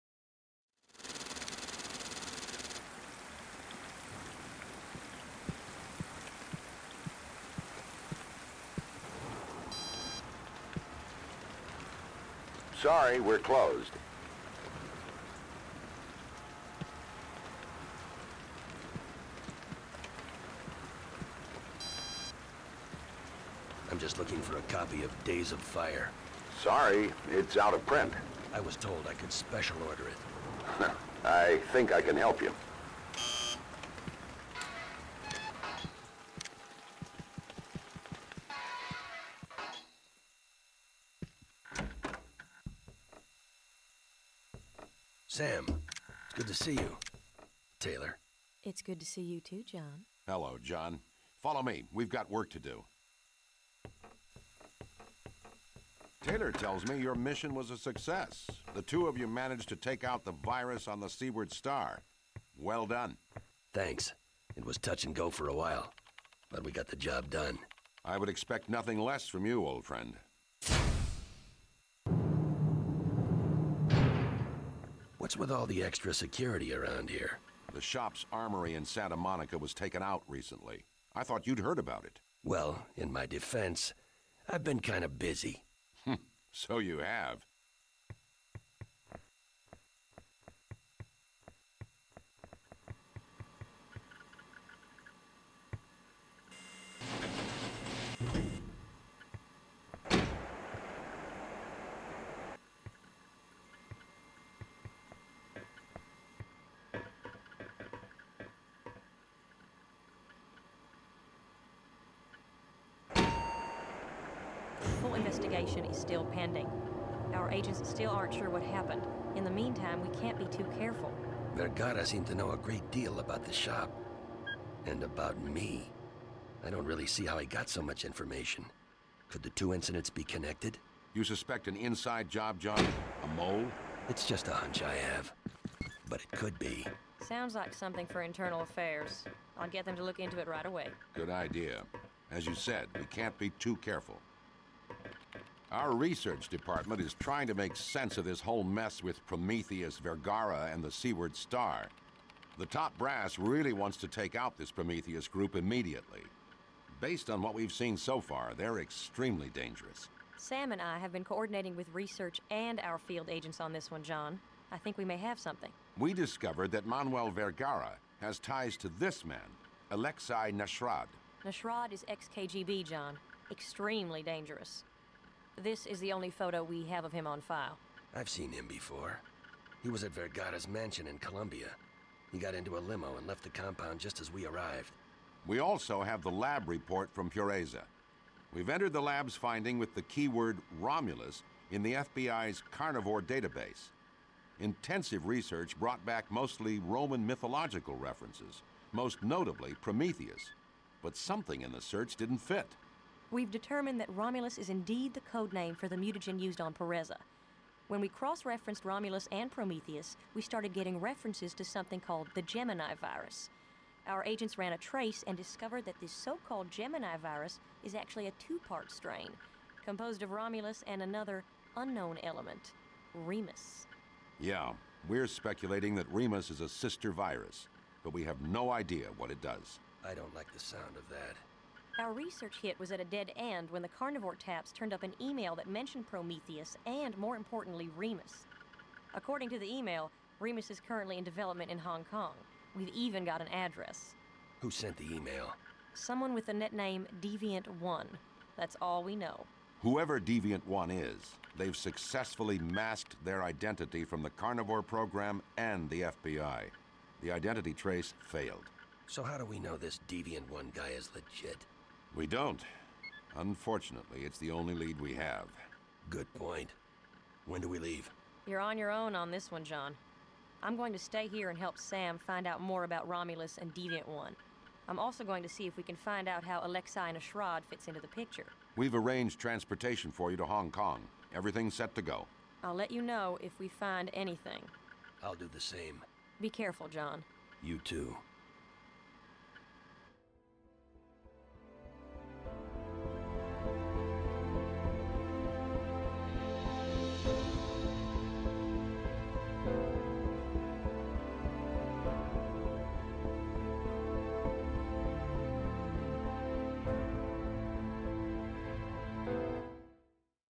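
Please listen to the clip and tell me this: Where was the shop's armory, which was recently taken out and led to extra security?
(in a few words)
Santa Monica.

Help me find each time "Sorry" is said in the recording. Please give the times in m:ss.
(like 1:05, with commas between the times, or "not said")
0:12, 0:26.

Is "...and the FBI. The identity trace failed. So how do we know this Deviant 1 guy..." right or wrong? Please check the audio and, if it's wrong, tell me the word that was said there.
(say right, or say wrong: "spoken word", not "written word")
right.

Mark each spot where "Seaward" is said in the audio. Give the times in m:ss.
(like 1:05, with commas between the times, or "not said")
1:01, 2:30.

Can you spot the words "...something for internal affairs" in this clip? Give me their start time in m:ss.
2:17.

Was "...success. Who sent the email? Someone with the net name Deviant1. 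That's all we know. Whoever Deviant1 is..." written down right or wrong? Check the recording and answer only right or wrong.
wrong.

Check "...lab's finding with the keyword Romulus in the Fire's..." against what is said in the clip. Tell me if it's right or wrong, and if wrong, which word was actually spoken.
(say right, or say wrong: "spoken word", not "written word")
wrong: "FBI", not "Fire".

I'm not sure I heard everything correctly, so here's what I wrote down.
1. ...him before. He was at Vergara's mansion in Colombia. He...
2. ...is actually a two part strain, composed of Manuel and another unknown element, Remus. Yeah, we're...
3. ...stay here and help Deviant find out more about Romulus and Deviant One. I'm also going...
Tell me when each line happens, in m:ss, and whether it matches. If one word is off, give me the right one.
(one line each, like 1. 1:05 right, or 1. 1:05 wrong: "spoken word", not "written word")
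1. 2:58 right
2. 3:37 wrong: "Romulus", not "Manuel"
3. 4:30 wrong: "Sam", not "Deviant".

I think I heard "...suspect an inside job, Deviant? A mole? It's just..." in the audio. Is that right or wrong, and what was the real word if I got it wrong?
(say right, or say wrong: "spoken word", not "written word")
wrong: "John", not "Deviant".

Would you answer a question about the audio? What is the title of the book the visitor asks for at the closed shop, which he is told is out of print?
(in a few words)
Days of Fire.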